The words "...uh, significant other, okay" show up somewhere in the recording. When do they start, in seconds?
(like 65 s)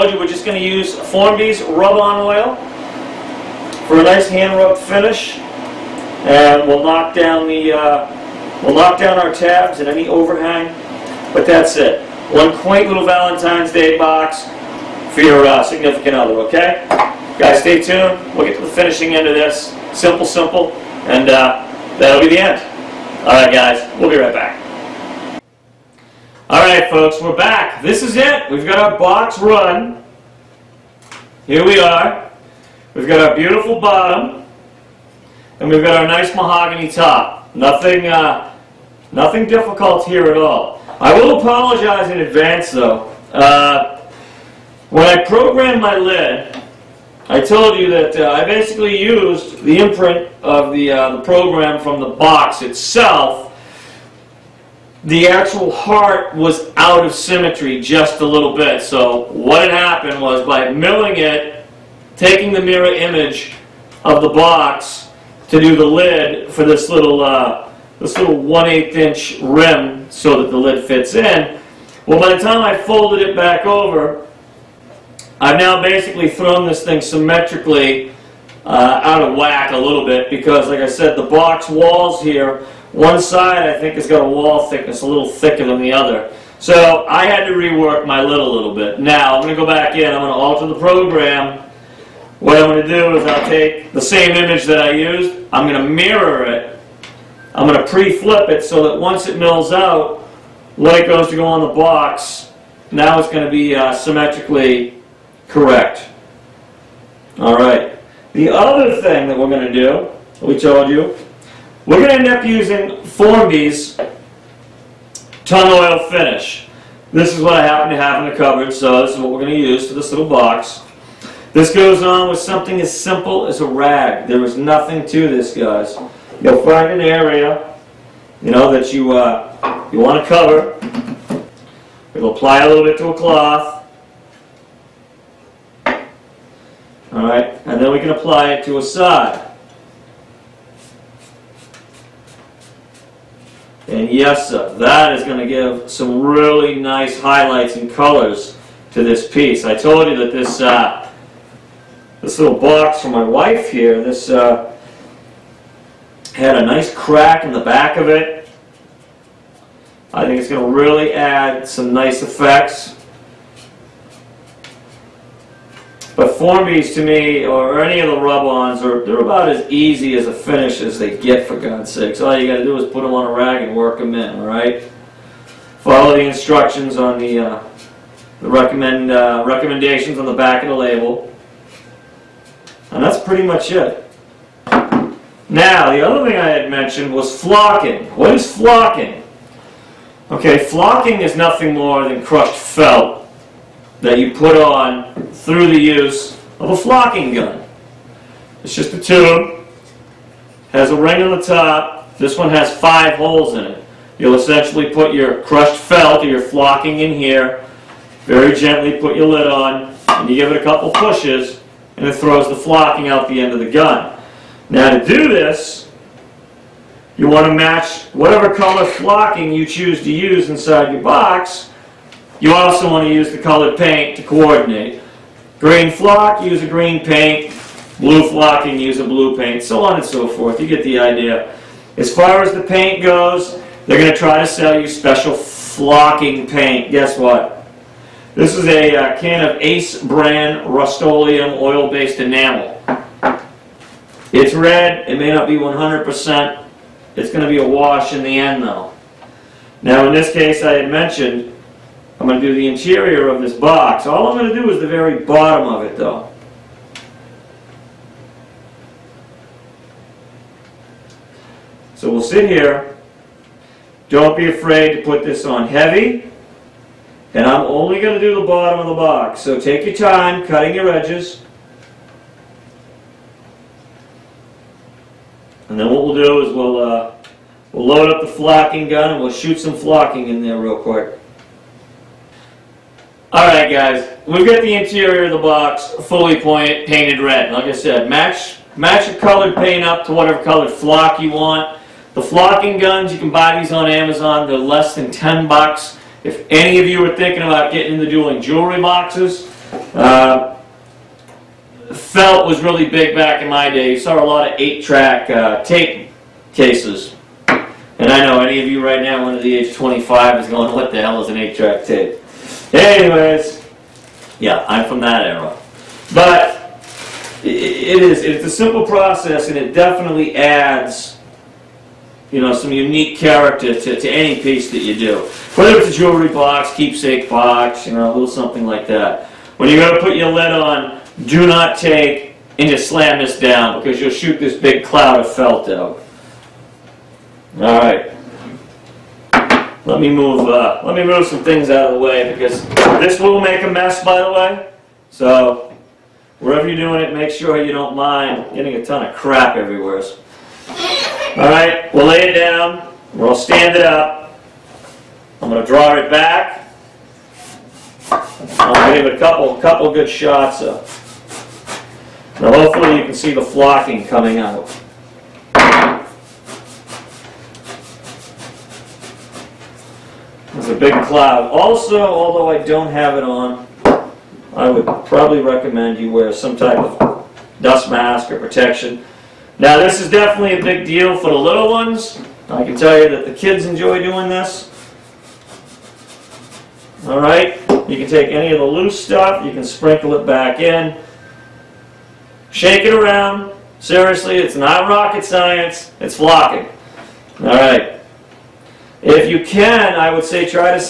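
15 s.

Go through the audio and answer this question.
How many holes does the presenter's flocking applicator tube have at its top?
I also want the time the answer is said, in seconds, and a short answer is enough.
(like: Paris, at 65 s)
5, at 202 s.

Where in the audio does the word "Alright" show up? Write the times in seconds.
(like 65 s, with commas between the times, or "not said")
283 s, 387 s.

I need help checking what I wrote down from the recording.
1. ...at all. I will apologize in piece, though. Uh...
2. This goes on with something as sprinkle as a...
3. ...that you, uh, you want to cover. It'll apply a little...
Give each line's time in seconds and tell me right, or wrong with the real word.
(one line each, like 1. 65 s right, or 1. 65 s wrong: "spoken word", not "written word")
1. 40 s wrong: "advance", not "piece"
2. 121 s wrong: "simple", not "sprinkle"
3. 128 s right.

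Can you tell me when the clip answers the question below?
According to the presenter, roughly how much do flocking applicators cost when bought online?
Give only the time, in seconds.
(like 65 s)
294 s.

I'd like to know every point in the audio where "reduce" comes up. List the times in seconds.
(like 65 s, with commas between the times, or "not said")
not said.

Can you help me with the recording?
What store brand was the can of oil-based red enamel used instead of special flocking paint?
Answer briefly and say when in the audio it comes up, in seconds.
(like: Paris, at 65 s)
Ace, at 239 s.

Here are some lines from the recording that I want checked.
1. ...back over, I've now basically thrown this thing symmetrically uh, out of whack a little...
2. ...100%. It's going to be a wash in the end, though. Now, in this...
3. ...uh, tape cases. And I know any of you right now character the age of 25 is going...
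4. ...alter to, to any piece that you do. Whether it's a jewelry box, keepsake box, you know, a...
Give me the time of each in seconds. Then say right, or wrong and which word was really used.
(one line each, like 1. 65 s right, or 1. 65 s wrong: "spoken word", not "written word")
1. 73 s right
2. 245 s right
3. 305 s wrong: "under", not "character"
4. 323 s wrong: "character", not "alter".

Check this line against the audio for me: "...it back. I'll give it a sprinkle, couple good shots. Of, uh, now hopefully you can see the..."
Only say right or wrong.
wrong.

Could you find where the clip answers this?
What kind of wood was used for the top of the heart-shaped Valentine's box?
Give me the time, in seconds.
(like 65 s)
36 s.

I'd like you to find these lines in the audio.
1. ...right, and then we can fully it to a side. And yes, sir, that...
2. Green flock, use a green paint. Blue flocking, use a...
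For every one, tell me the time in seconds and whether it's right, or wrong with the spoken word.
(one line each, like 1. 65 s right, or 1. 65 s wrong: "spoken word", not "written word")
1. 137 s wrong: "apply", not "fully"
2. 225 s right.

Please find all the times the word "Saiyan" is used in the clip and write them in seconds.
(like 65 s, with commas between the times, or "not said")
not said.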